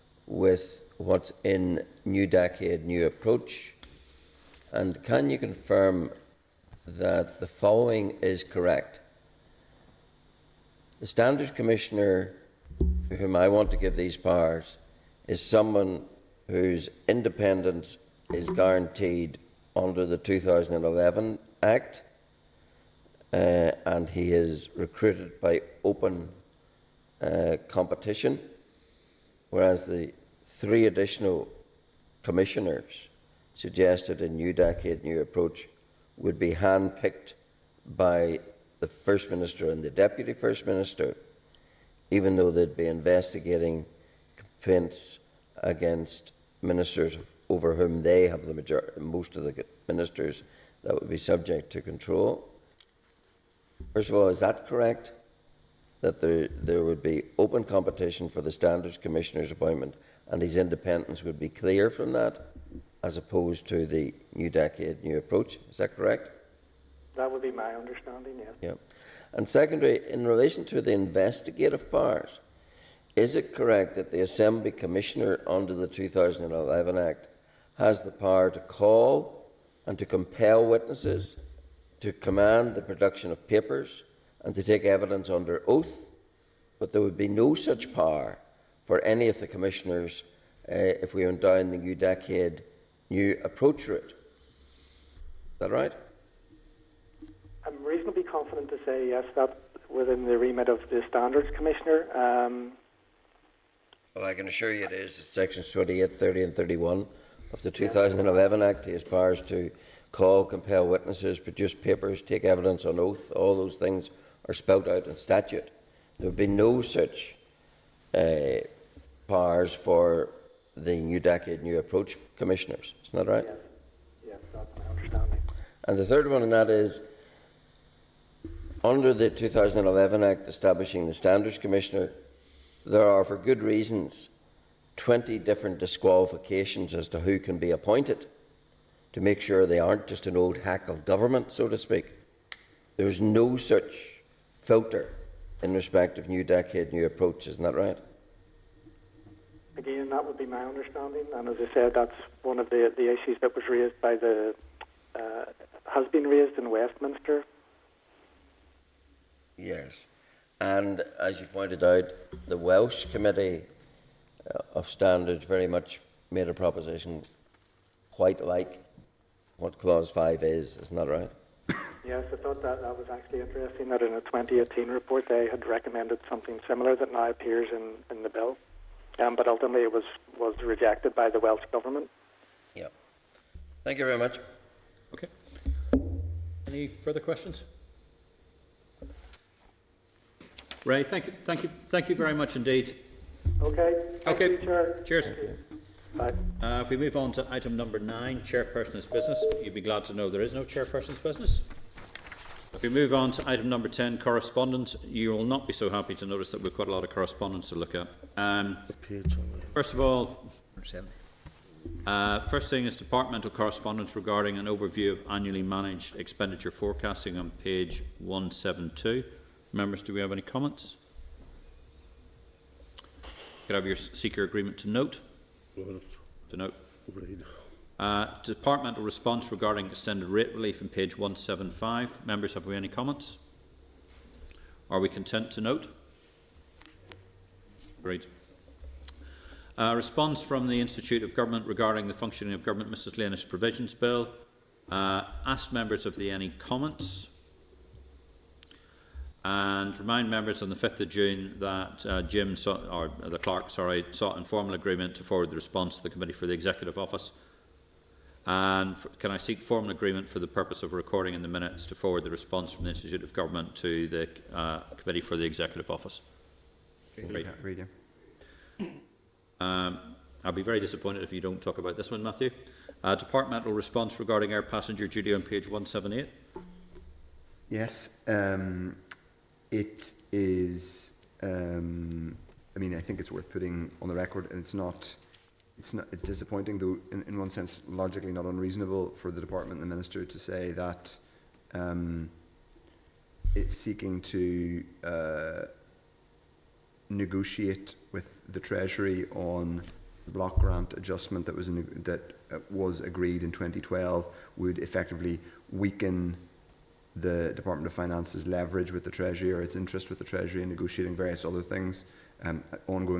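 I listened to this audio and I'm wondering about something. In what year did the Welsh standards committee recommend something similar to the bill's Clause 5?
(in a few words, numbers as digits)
2018.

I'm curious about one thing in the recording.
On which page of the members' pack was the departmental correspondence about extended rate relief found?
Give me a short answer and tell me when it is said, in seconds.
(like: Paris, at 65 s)
175, at 230 s.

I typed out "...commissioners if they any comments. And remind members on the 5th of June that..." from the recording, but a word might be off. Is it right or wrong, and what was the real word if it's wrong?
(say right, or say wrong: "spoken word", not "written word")
wrong: "members", not "commissioners".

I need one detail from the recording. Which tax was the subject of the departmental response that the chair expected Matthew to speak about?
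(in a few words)
Air passenger duty.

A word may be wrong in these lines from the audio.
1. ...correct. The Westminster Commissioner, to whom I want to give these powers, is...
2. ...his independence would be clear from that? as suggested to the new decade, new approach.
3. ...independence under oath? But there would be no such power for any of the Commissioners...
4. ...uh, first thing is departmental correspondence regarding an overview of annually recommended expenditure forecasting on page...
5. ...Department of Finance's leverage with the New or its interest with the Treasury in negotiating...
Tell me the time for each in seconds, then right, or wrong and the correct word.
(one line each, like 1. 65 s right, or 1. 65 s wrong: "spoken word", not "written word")
1. 8 s wrong: "Standards", not "Westminster"
2. 60 s wrong: "opposed", not "suggested"
3. 84 s wrong: "evidence", not "independence"
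4. 212 s wrong: "managed", not "recommended"
5. 307 s wrong: "Treasury", not "New".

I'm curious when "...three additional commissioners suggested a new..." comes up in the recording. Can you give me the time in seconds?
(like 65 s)
30 s.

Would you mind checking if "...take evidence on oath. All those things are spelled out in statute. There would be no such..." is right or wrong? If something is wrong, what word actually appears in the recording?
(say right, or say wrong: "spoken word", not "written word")
right.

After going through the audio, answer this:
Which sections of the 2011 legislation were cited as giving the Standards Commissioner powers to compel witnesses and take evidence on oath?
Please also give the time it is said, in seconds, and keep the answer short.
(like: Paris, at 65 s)
Sections 28, 30 and 31, at 105 s.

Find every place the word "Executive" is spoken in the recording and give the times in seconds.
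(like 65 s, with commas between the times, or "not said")
256 s, 265 s.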